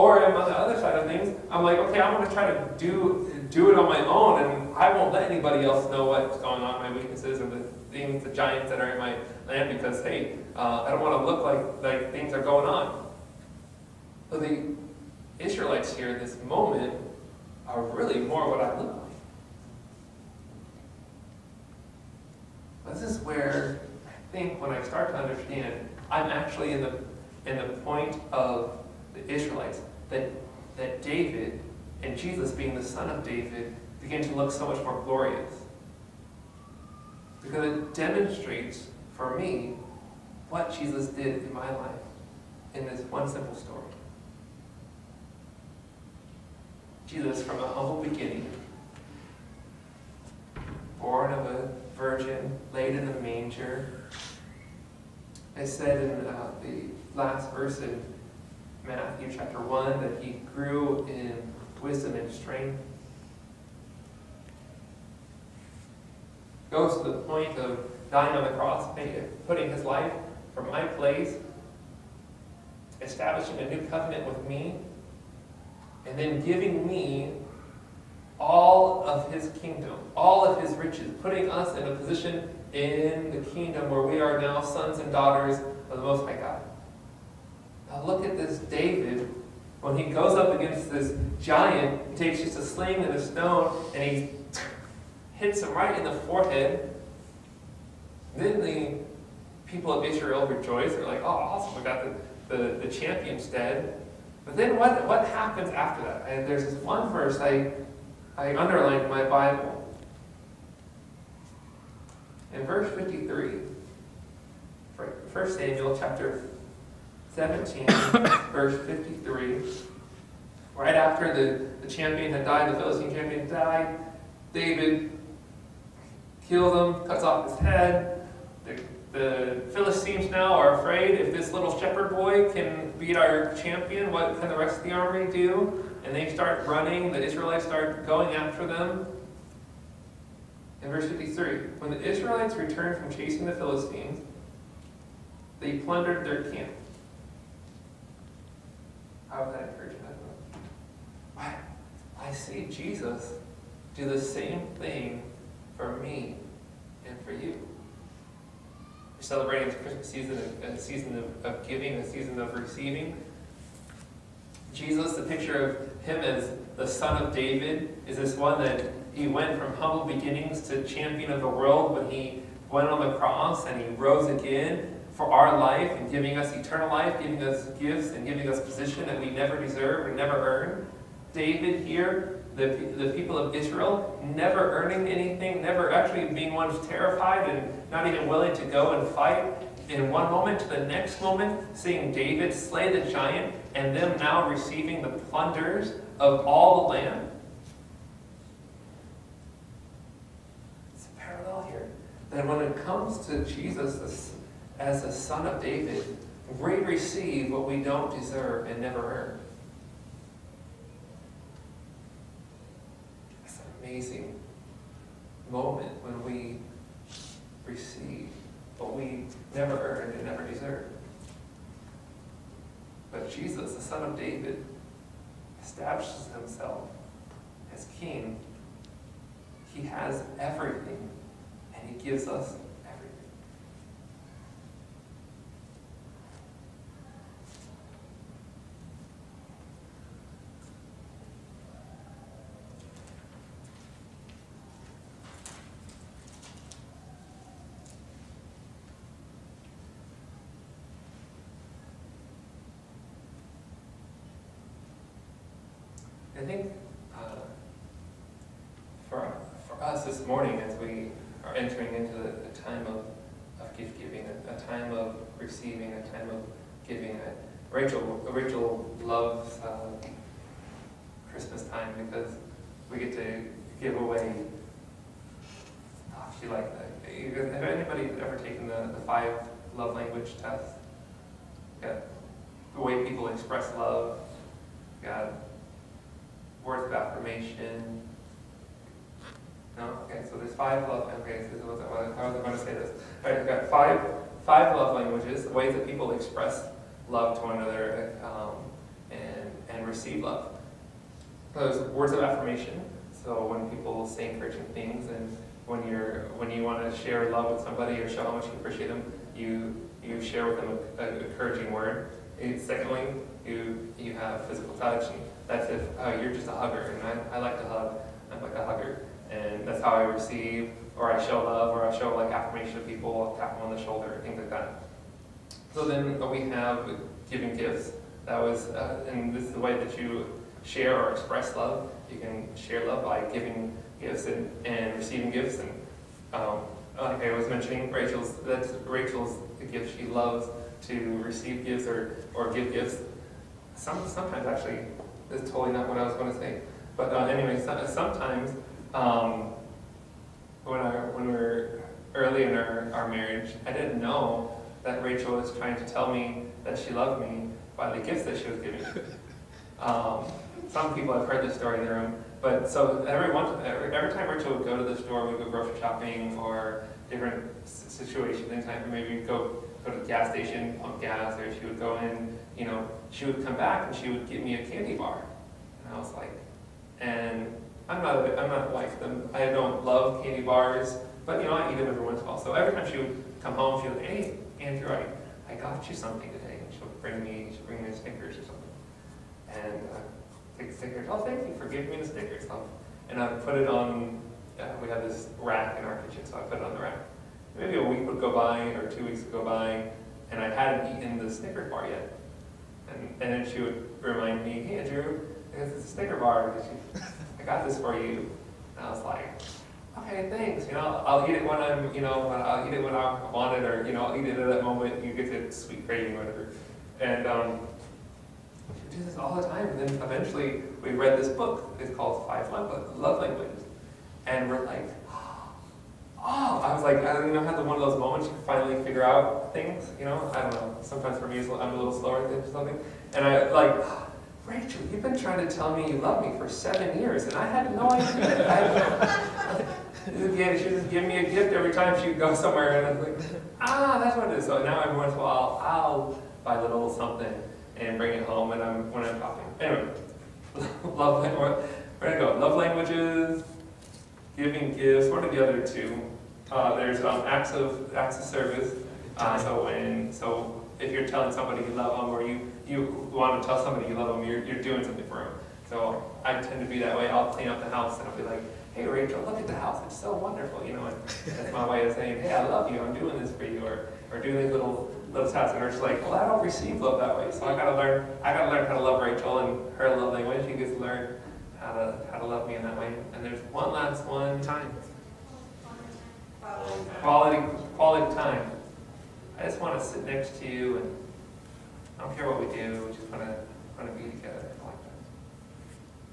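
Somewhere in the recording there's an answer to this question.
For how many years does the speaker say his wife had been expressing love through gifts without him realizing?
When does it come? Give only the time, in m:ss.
7:16.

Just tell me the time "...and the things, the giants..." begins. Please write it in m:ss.
0:07.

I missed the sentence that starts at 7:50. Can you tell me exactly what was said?
You know, and that's my way of saying, Hey, I love you.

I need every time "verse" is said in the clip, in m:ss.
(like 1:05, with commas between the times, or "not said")
0:57, 1:47, 1:52, 1:58, 2:20.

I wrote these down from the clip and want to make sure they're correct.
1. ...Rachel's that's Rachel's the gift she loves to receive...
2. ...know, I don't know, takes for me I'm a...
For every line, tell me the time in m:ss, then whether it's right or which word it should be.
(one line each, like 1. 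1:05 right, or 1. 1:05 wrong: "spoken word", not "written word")
1. 5:37 right
2. 7:10 wrong: "sometimes", not "takes".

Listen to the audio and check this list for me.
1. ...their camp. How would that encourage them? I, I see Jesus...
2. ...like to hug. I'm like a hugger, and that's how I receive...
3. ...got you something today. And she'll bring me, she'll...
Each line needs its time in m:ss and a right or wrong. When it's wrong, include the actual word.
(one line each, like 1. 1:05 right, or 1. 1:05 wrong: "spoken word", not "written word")
1. 2:26 right
2. 5:17 right
3. 6:25 right.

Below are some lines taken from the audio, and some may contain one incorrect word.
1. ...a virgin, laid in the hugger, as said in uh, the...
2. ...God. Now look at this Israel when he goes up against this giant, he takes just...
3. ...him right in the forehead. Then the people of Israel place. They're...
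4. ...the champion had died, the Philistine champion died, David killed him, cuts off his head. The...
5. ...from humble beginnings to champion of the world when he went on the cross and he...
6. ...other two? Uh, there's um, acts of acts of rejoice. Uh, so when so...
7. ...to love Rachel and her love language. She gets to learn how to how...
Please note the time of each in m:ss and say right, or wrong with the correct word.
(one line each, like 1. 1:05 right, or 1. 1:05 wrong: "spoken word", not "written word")
1. 0:51 wrong: "manger", not "hugger"
2. 1:26 wrong: "David", not "Israel"
3. 1:35 wrong: "rejoice", not "place"
4. 2:01 right
5. 2:49 right
6. 7:35 wrong: "service", not "rejoice"
7. 7:58 right.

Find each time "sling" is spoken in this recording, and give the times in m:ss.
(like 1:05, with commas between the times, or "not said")
1:32.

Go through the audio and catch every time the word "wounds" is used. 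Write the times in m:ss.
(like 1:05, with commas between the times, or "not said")
not said.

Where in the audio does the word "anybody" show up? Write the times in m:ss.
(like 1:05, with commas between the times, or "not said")
0:05, 4:37.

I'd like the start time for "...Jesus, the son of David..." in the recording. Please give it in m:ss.
3:43.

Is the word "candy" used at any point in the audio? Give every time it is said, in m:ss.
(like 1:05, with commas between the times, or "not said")
6:14, 6:20.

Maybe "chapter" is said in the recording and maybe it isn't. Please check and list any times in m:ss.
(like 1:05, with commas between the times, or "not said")
0:59, 1:55.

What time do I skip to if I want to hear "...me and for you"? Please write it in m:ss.
2:35.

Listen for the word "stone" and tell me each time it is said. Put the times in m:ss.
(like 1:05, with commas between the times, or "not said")
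1:33.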